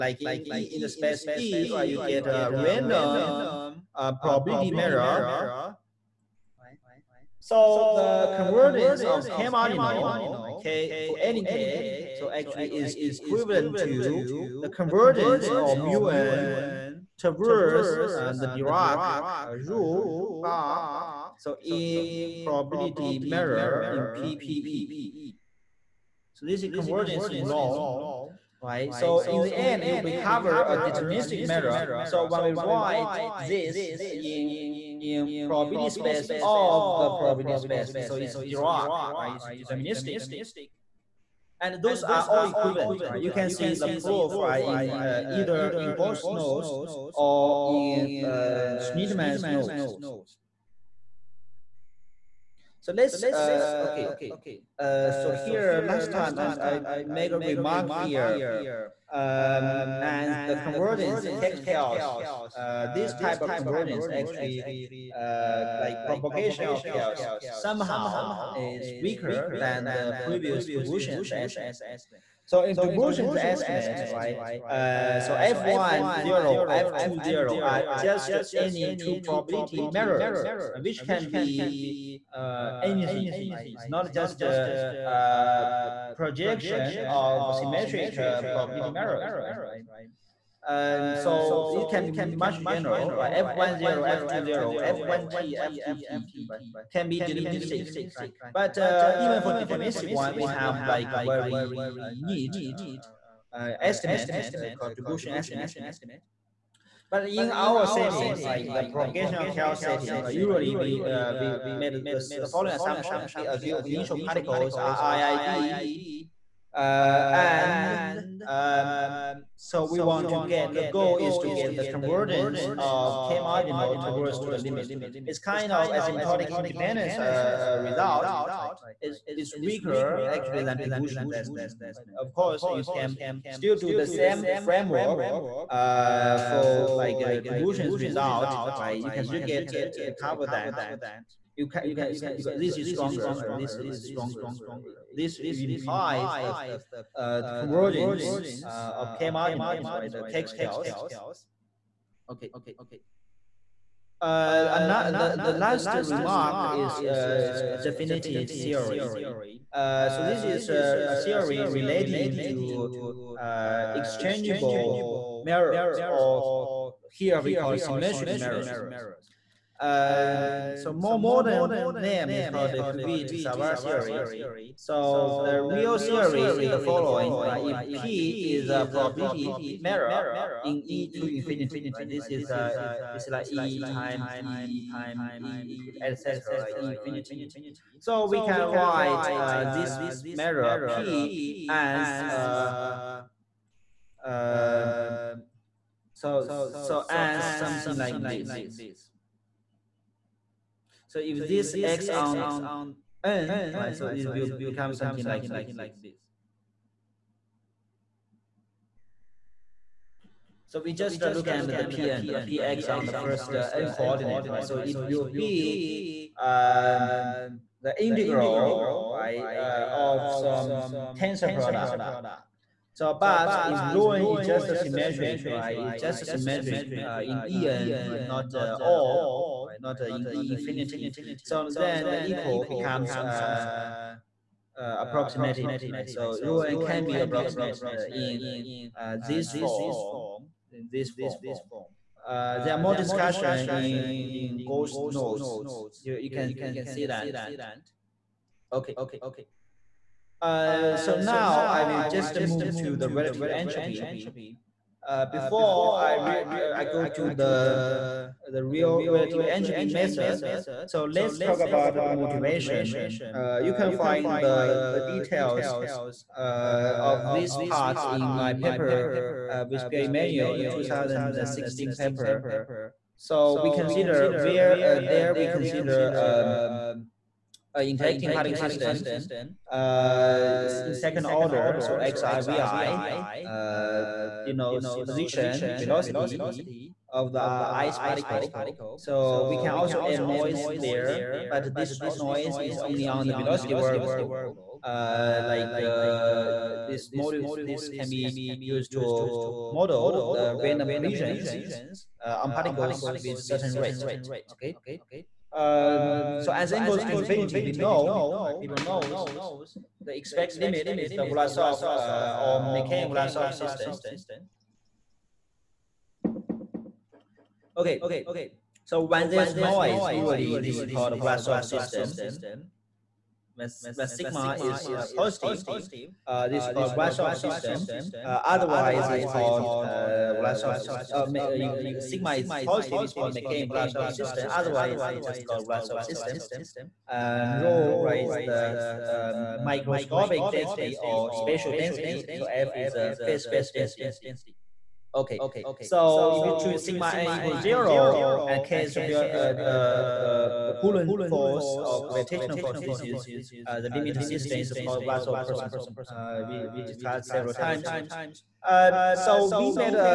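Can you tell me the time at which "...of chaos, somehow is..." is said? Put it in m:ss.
1:06.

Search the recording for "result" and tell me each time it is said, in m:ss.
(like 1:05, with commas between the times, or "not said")
2:07, 2:17.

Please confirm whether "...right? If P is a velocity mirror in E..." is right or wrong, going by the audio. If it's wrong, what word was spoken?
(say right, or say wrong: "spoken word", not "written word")
wrong: "probability", not "velocity".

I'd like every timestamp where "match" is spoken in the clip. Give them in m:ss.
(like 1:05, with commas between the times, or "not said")
not said.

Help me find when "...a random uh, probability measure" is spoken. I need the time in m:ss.
0:02.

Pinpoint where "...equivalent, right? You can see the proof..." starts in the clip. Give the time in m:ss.
0:42.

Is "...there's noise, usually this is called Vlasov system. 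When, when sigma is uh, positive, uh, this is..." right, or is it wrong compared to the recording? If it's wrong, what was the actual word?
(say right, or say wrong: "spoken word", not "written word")
right.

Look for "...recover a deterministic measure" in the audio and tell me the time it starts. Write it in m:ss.
0:29.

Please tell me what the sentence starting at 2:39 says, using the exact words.
Uh, so this is a, a theory relating to uh, exchangeable mirrors, or here we call symmetric mirrors.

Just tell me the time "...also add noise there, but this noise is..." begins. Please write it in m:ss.
4:49.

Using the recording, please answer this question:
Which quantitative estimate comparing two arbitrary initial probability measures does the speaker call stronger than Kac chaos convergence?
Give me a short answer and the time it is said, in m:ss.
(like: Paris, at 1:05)
Dobrushin's estimate, at 2:10.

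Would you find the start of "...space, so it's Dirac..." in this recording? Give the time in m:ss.
0:37.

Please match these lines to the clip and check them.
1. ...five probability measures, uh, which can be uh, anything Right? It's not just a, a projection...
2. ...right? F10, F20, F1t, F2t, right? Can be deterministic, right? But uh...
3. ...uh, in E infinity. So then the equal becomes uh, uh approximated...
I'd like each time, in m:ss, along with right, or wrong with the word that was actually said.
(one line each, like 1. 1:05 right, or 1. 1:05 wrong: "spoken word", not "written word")
1. 1:19 wrong: "two", not "five"
2. 1:33 right
3. 3:49 right.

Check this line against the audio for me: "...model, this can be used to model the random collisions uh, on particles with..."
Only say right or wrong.
right.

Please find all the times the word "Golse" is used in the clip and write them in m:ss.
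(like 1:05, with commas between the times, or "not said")
0:45, 4:04.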